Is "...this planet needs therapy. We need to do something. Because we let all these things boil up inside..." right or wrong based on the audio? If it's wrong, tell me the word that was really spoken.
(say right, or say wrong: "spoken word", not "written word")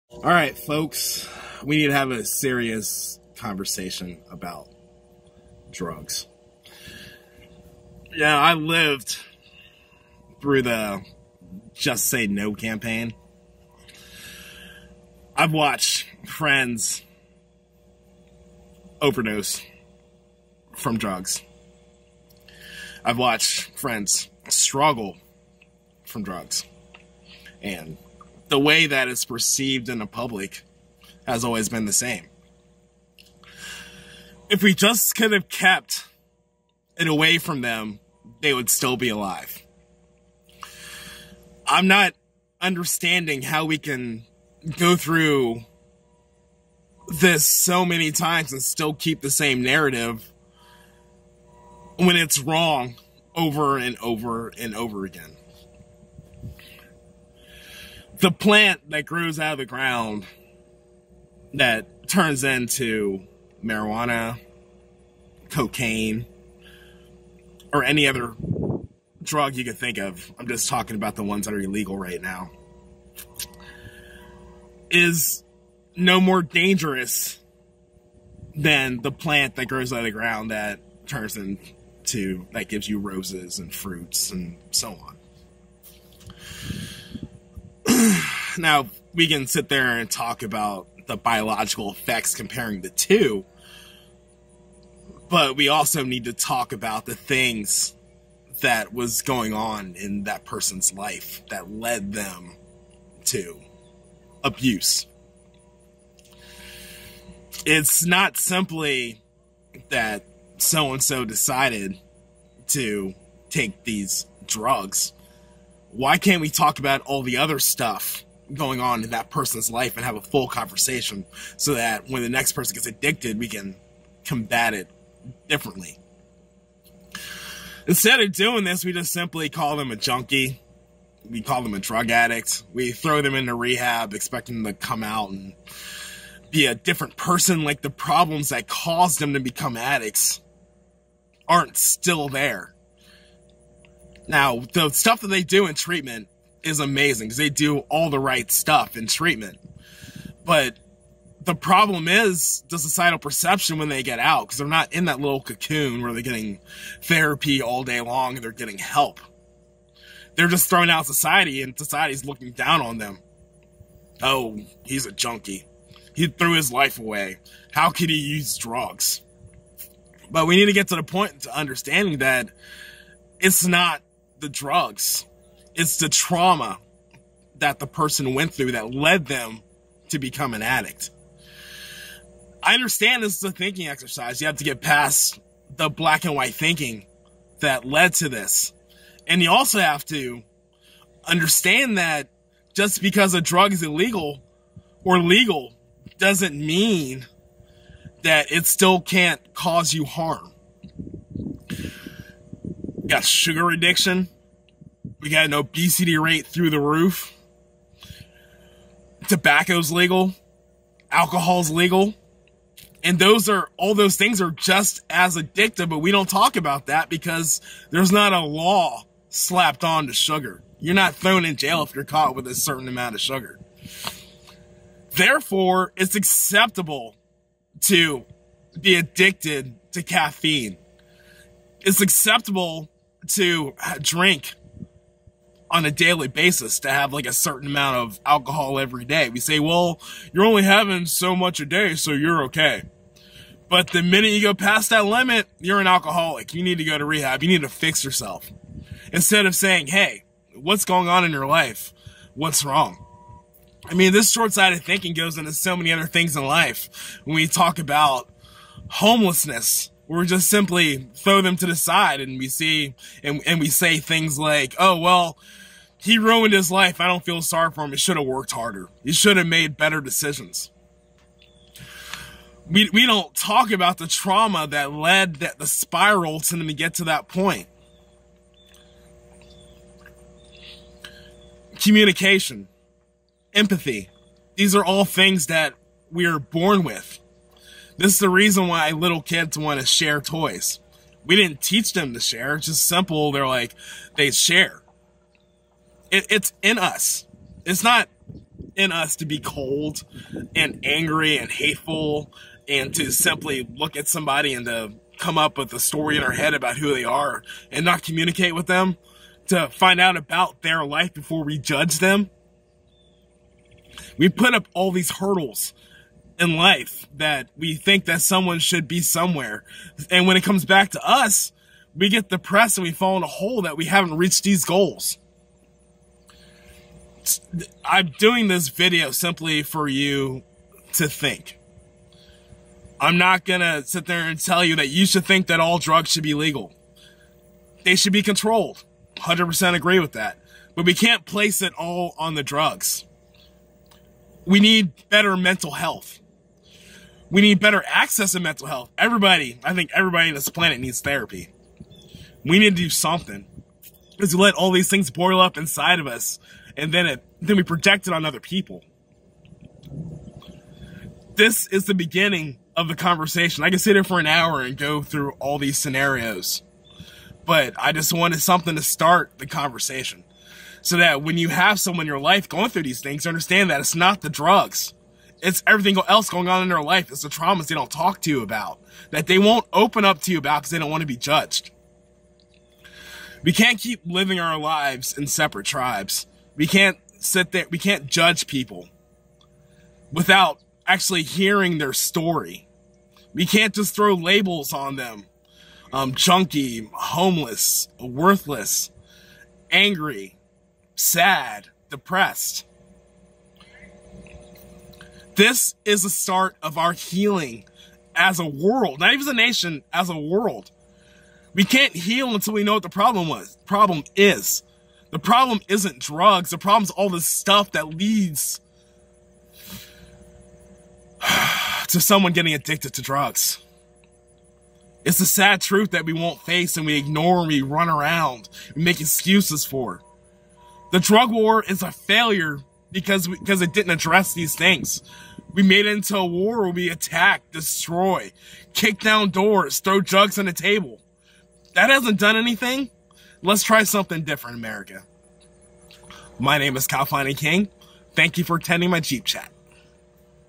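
right.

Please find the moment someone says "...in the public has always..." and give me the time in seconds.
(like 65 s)
29 s.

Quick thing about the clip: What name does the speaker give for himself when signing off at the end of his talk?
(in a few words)
Khalfani King.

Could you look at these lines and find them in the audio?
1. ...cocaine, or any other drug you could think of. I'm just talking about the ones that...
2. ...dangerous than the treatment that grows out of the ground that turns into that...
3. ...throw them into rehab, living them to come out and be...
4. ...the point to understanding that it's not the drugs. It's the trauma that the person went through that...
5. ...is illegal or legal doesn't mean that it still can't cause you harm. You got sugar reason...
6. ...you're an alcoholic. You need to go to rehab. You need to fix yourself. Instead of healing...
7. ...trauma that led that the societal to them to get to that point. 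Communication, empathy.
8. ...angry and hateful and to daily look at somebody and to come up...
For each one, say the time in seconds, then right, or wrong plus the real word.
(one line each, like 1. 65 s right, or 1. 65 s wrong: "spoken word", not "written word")
1. 65 s right
2. 76 s wrong: "plant", not "treatment"
3. 132 s wrong: "expecting", not "living"
4. 170 s right
5. 193 s wrong: "addiction", not "reason"
6. 245 s wrong: "saying", not "healing"
7. 274 s wrong: "spiral", not "societal"
8. 300 s wrong: "simply", not "daily".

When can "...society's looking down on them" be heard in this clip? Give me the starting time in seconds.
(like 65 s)
161 s.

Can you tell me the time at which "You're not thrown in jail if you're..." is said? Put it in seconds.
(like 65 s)
220 s.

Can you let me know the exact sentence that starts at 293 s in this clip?
They're like, they share it, it's in us.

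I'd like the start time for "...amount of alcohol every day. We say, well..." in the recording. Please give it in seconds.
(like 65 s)
237 s.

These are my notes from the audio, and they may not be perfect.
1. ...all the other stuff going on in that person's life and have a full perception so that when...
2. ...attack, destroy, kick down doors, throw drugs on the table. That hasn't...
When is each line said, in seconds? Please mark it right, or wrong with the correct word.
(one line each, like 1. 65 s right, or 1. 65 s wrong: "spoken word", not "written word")
1. 117 s wrong: "conversation", not "perception"
2. 436 s right.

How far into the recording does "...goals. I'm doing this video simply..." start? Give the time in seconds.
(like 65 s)
324 s.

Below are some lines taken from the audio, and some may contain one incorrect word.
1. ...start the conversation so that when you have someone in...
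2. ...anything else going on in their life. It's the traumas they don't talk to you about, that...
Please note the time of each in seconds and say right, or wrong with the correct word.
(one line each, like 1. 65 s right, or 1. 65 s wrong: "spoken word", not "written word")
1. 368 s right
2. 375 s wrong: "everything", not "anything".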